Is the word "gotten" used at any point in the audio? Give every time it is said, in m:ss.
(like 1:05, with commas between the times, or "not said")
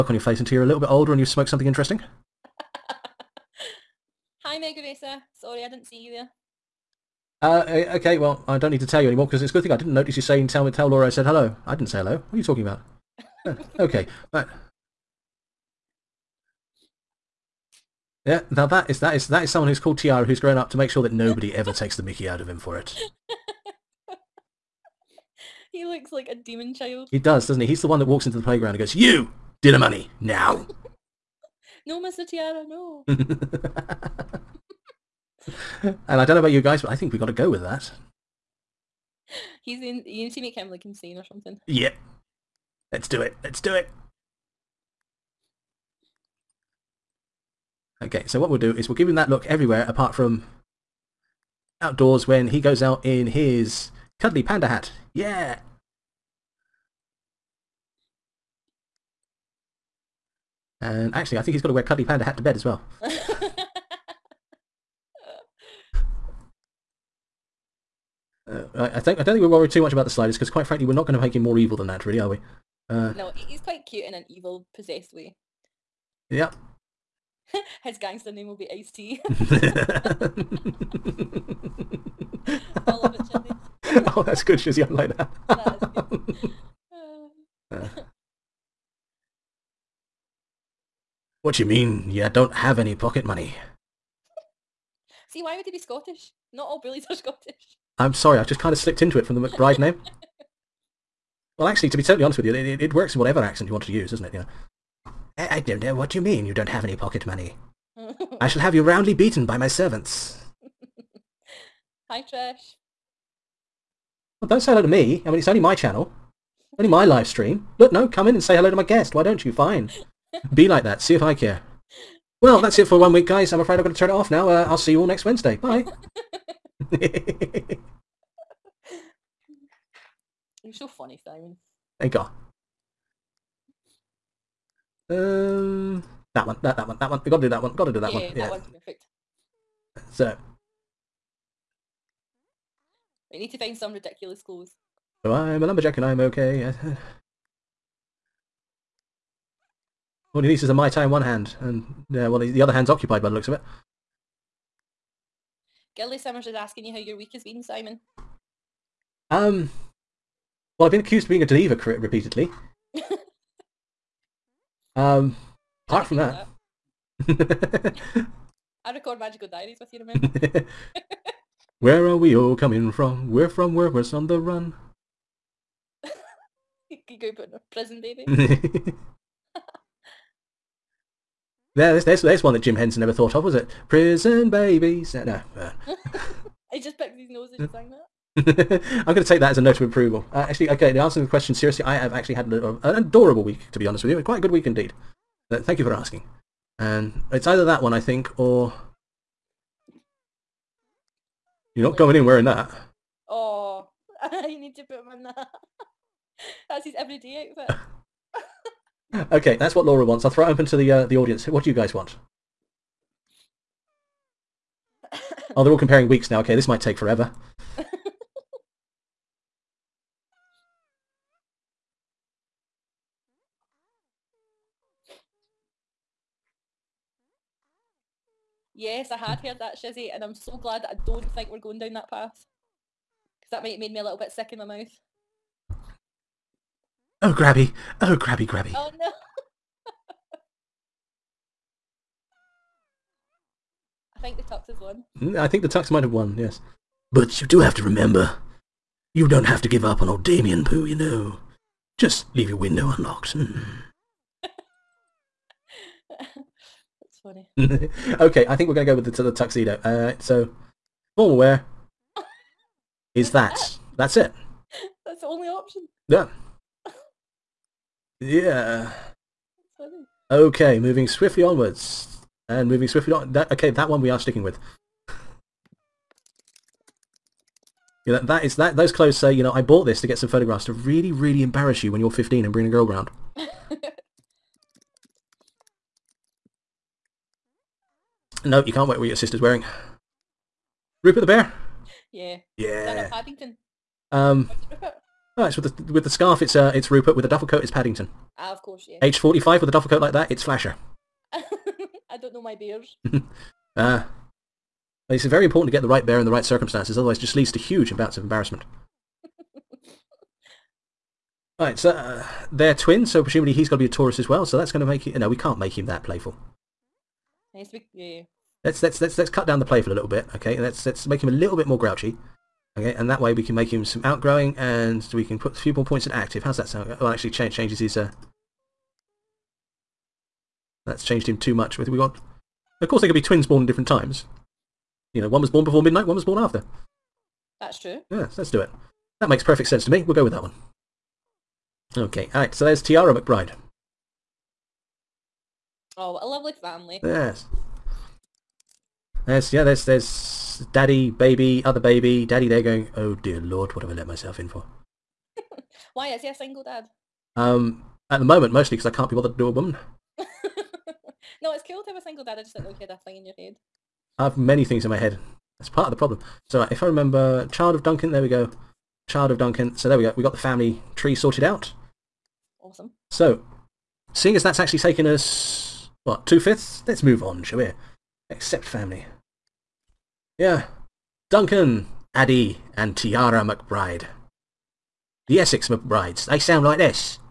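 not said.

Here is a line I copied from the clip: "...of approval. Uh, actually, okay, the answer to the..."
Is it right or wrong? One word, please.
right.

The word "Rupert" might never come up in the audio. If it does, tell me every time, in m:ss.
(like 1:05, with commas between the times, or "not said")
4:51, 4:56.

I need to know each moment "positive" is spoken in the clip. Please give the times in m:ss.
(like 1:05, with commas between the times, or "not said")
not said.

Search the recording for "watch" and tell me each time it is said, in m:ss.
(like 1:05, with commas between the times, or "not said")
not said.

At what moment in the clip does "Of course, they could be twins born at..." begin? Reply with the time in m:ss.
5:32.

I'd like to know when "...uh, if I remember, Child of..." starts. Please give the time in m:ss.
6:06.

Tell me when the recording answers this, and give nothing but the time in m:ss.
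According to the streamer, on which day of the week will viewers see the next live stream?
2:05.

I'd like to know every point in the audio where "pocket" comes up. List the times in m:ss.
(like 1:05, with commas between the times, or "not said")
1:32, 1:46.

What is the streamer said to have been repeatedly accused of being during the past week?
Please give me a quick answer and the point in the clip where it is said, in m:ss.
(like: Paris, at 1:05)
A diva, at 2:41.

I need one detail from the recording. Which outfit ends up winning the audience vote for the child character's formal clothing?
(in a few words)
Tuxedo.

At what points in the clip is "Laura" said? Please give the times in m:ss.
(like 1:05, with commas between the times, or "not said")
0:10, 3:29.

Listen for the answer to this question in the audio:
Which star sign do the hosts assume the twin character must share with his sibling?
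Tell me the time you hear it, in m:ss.
5:13.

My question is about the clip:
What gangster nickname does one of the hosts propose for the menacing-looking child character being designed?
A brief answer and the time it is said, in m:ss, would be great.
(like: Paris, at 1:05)
Ice T, at 1:18.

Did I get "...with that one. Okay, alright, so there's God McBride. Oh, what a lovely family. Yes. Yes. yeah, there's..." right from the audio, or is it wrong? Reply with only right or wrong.
wrong.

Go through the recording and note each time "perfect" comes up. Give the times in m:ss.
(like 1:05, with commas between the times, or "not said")
2:18, 5:39.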